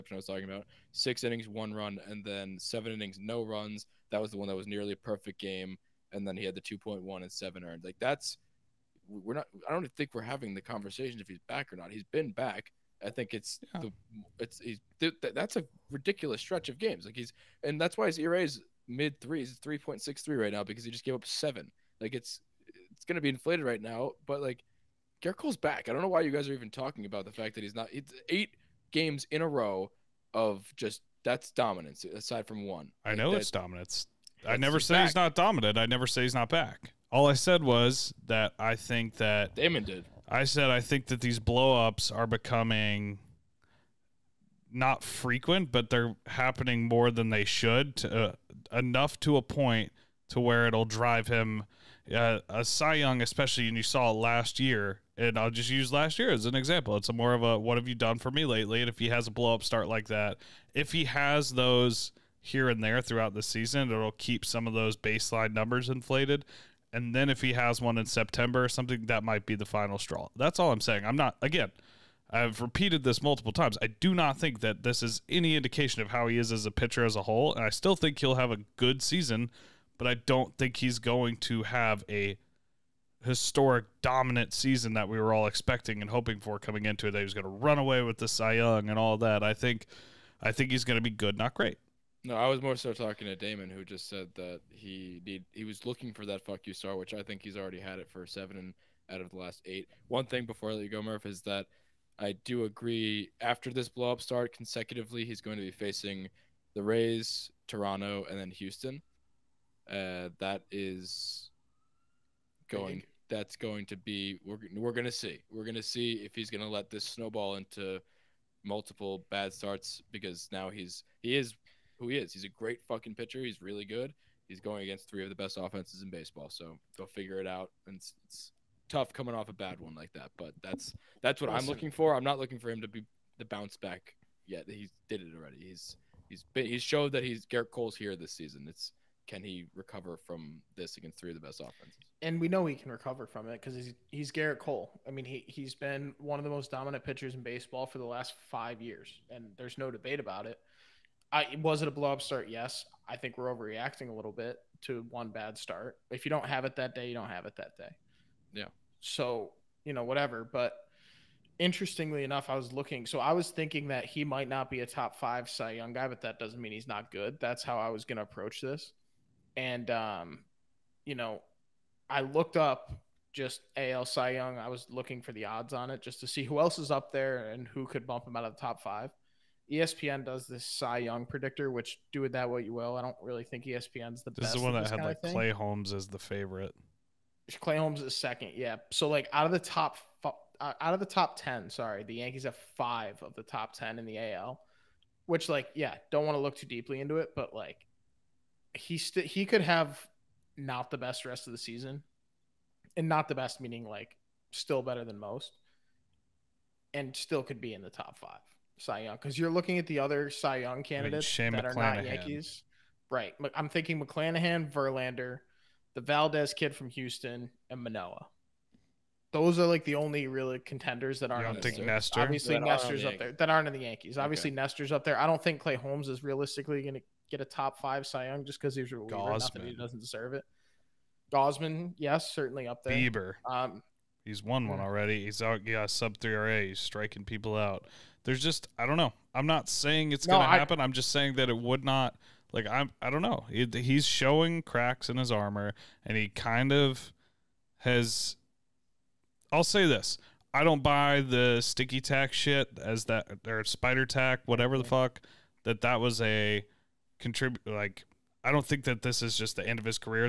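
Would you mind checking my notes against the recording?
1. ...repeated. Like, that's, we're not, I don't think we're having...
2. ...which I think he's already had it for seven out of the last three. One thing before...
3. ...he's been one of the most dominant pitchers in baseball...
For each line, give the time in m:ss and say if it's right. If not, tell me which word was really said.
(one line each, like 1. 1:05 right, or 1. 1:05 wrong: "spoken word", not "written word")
1. 0:07 wrong: "earned", not "repeated"
2. 1:36 wrong: "eight", not "three"
3. 2:25 right.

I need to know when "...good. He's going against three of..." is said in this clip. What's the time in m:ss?
2:03.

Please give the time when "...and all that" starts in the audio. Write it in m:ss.
1:28.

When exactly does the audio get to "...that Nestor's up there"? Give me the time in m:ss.
3:42.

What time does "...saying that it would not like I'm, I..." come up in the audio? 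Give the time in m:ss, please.
4:01.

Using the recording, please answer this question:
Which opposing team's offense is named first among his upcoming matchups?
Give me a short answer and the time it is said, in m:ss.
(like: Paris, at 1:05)
Rays, at 1:46.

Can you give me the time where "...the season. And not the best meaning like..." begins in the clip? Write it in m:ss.
3:21.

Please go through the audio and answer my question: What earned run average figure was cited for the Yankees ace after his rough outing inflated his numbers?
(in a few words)
3.63.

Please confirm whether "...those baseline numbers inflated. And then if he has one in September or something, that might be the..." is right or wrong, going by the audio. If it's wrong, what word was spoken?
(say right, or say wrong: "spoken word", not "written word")
right.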